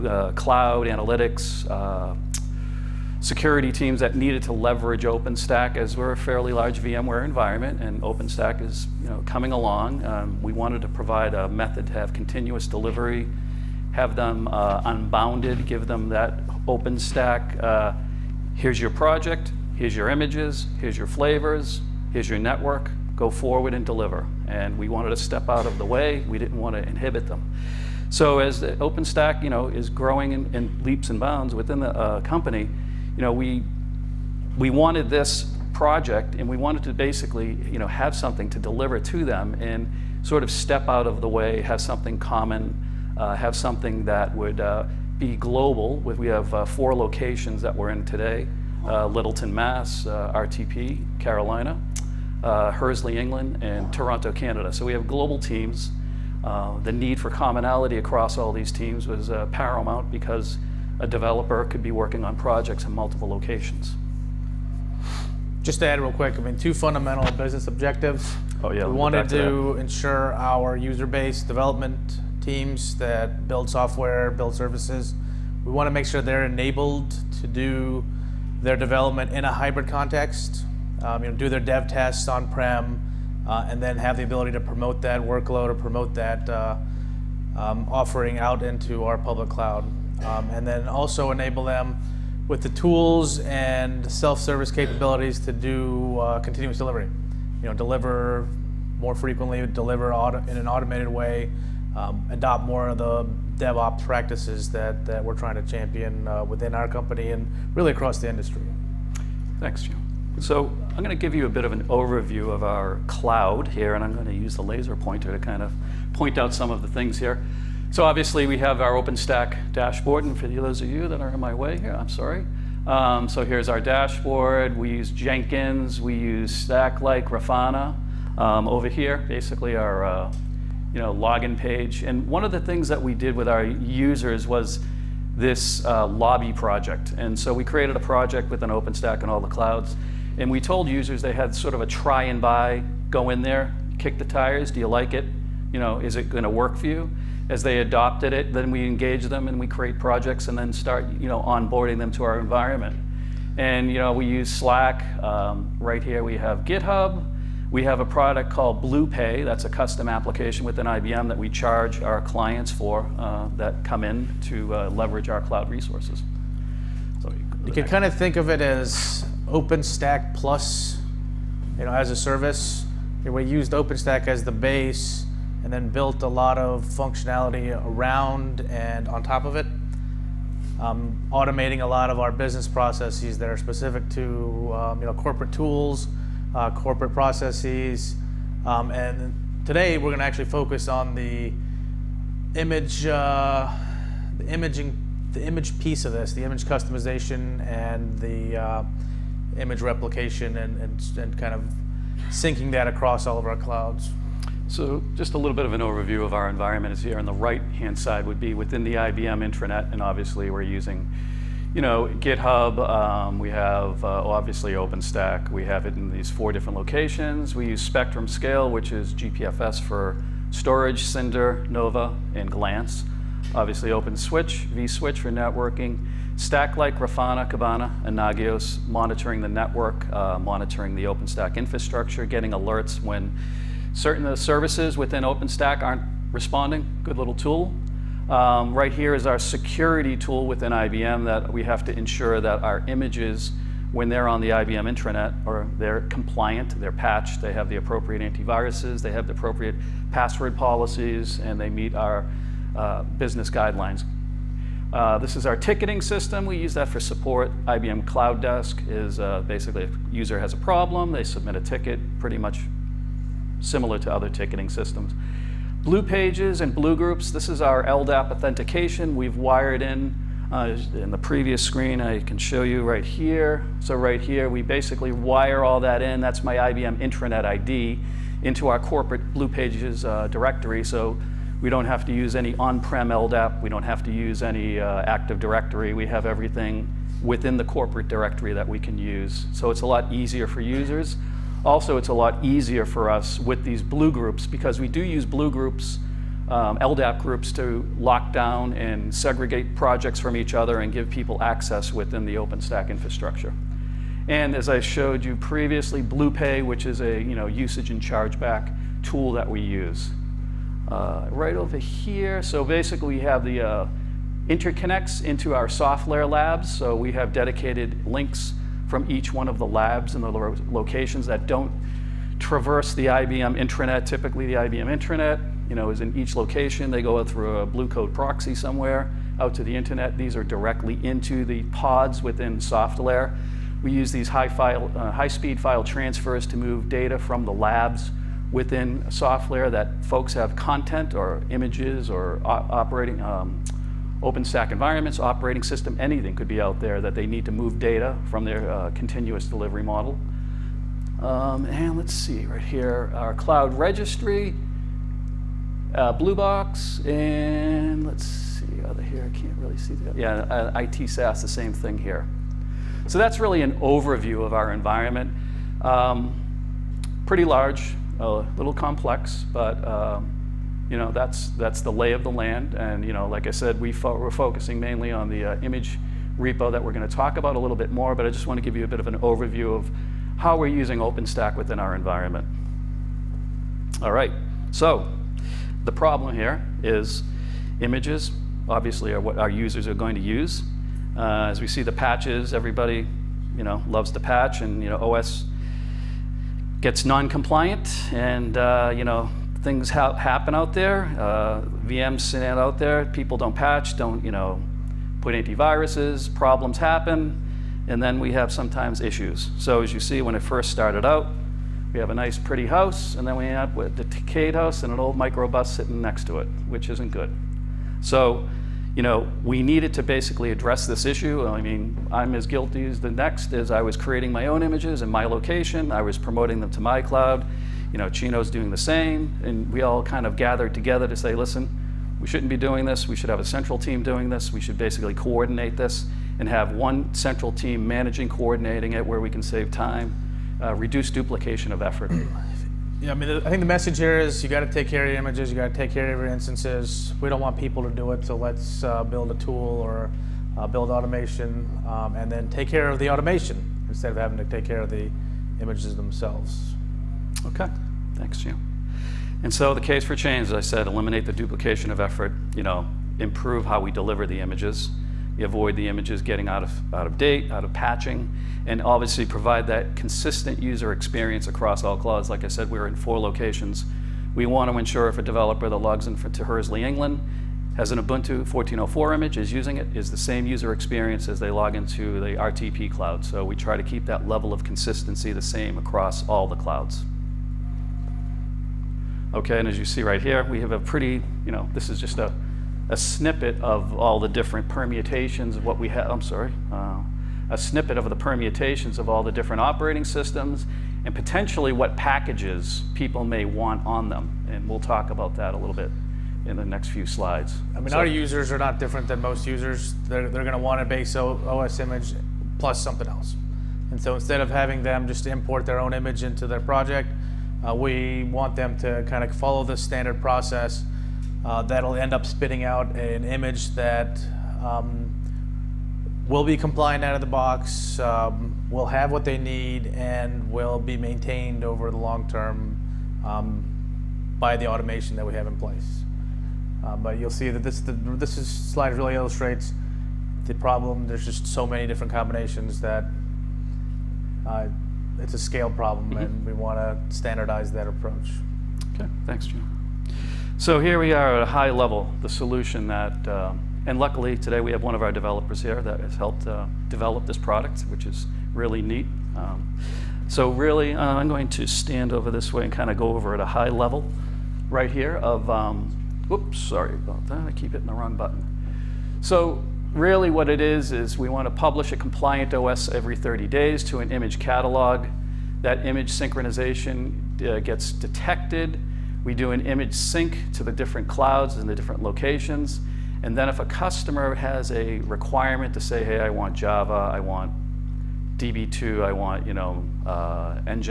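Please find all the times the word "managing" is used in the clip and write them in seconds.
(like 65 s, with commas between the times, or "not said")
437 s.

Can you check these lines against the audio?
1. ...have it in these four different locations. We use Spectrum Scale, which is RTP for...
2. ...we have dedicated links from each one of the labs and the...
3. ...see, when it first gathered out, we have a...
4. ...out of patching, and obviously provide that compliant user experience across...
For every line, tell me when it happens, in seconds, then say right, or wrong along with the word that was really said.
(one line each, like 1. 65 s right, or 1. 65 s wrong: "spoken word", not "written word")
1. 215 s wrong: "GPFS", not "RTP"
2. 316 s right
3. 409 s wrong: "started", not "gathered"
4. 467 s wrong: "consistent", not "compliant".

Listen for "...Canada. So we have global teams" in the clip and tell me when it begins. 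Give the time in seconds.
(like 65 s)
54 s.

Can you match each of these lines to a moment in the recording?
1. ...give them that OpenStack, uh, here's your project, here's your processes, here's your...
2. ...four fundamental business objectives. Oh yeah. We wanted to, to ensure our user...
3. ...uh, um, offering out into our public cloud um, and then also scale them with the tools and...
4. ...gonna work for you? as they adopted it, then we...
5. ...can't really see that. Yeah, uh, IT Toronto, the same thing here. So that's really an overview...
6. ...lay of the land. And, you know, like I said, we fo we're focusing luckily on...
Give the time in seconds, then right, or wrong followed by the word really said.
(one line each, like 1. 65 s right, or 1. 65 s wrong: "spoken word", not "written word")
1. 15 s wrong: "images", not "processes"
2. 66 s wrong: "two", not "four"
3. 86 s wrong: "enable", not "scale"
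4. 146 s right
5. 359 s wrong: "SaaS", not "Toronto"
6. 371 s wrong: "mainly", not "luckily".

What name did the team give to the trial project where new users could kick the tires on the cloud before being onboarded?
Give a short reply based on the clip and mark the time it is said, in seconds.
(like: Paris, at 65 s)
lobby project, at 136 s.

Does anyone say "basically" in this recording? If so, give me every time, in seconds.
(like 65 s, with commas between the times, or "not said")
36 s, 129 s, 259 s, 274 s, 312 s, 420 s, 434 s.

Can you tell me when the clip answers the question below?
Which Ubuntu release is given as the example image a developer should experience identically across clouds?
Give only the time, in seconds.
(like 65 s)
477 s.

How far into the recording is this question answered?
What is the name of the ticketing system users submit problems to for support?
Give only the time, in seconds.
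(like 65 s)
257 s.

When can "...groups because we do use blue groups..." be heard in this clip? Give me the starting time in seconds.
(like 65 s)
294 s.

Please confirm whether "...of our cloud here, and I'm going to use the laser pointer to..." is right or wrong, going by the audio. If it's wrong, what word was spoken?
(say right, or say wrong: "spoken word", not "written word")
right.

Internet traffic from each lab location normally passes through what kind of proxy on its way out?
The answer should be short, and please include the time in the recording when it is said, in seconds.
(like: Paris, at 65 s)
Blue Coat proxy, at 327 s.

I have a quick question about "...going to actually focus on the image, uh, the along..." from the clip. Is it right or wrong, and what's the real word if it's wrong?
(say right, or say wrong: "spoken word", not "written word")
wrong: "imaging", not "along".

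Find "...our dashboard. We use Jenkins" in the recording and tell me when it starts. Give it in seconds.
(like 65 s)
123 s.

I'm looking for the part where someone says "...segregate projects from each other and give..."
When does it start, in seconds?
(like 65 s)
299 s.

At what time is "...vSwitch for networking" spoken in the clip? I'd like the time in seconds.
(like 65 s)
224 s.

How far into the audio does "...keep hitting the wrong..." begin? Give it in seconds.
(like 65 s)
567 s.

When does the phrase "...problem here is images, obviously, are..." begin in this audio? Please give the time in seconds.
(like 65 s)
385 s.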